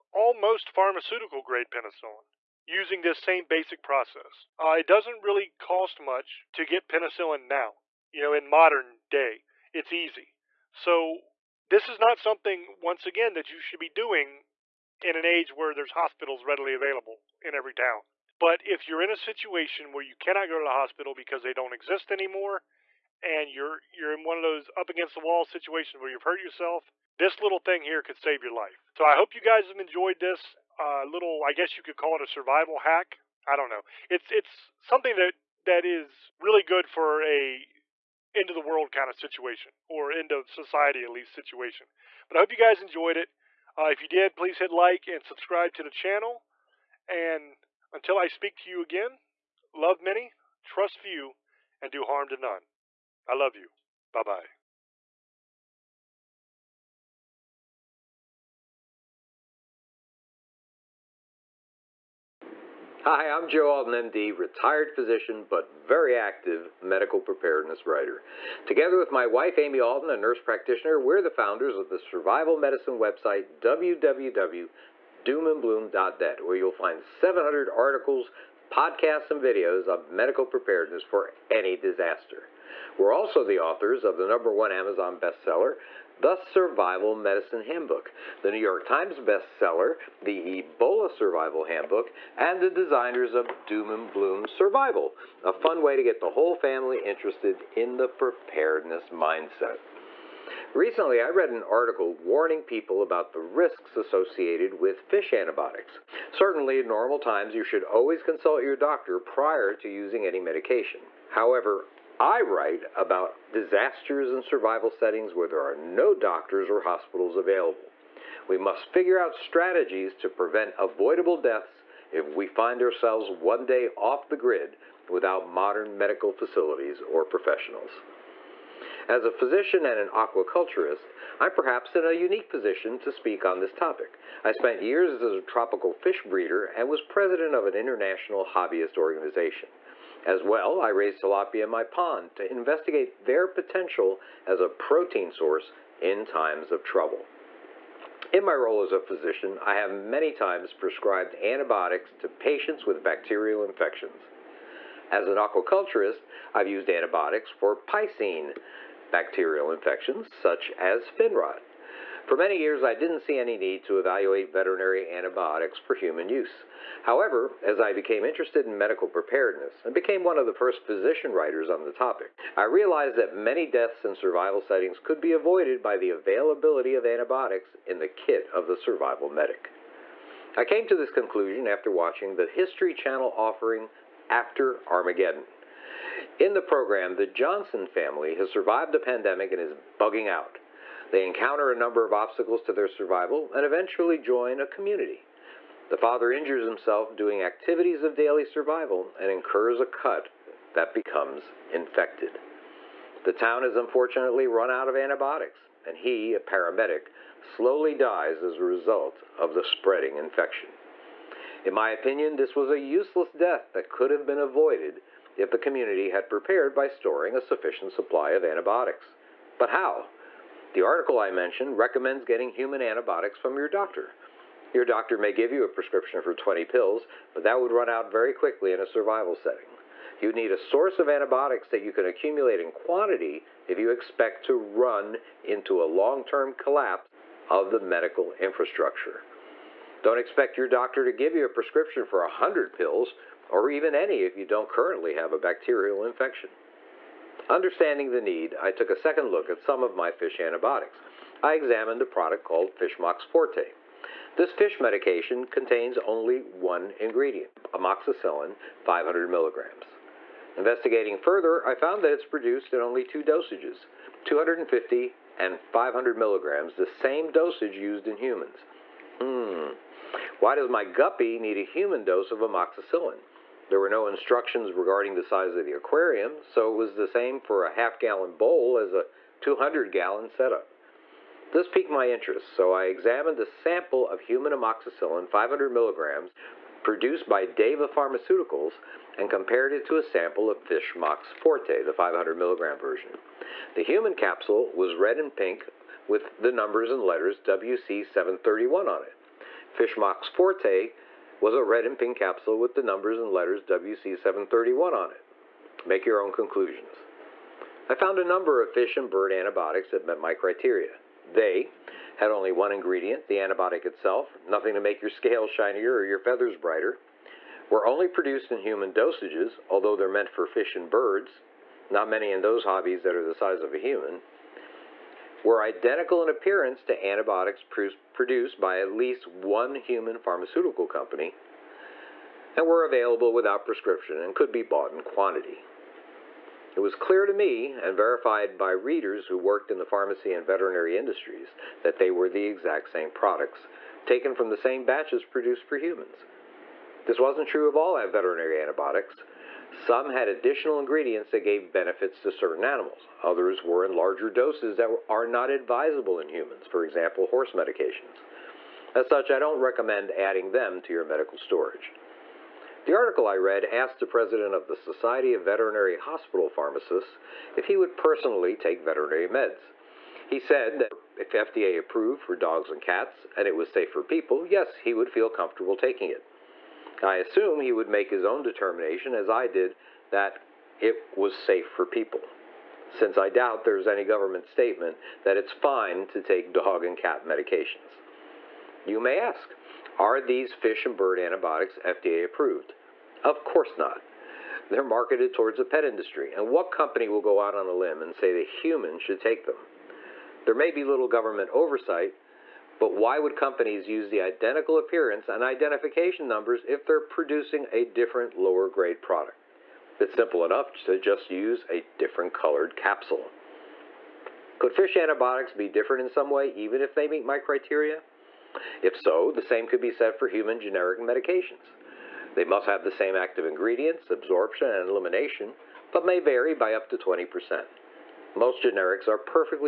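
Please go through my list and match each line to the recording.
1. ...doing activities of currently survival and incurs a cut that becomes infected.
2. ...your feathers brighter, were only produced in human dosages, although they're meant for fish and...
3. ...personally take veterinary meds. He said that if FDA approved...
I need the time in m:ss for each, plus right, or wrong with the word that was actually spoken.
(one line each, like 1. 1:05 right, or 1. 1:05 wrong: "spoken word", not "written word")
1. 3:17 wrong: "daily", not "currently"
2. 5:16 right
3. 6:07 right.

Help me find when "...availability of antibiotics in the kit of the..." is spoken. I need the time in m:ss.
2:56.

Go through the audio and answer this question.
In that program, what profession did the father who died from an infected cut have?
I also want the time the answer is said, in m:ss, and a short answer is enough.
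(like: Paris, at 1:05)
paramedic, at 3:26.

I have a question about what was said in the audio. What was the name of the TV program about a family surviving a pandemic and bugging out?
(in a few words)
After Armageddon.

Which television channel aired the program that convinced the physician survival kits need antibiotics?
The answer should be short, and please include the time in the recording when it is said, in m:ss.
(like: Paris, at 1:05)
History Channel, at 3:02.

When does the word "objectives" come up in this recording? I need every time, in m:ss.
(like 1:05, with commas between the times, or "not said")
not said.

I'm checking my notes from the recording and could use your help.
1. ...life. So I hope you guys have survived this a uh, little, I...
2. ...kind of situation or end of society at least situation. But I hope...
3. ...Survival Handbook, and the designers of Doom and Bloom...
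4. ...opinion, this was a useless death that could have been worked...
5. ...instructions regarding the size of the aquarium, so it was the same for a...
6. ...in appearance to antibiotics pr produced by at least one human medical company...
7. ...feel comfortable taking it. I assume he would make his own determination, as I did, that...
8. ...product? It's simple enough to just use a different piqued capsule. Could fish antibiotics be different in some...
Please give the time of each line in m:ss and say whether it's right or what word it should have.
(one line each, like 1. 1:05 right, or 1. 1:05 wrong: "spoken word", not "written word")
1. 0:28 wrong: "enjoyed", not "survived"
2. 0:38 right
3. 1:31 right
4. 3:31 wrong: "avoided", not "worked"
5. 4:34 right
6. 5:26 wrong: "pharmaceutical", not "medical"
7. 6:15 right
8. 6:49 wrong: "colored", not "piqued".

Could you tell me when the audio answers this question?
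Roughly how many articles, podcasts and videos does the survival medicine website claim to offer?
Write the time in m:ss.
1:17.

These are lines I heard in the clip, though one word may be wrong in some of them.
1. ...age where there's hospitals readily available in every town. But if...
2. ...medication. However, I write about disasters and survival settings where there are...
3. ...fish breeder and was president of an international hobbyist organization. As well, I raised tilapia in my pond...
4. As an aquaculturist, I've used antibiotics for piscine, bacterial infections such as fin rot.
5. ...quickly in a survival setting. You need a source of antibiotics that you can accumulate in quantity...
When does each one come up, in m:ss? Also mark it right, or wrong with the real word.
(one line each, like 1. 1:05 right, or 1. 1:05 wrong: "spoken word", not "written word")
1. 0:15 right
2. 1:50 right
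3. 2:15 right
4. 2:35 right
5. 3:48 right.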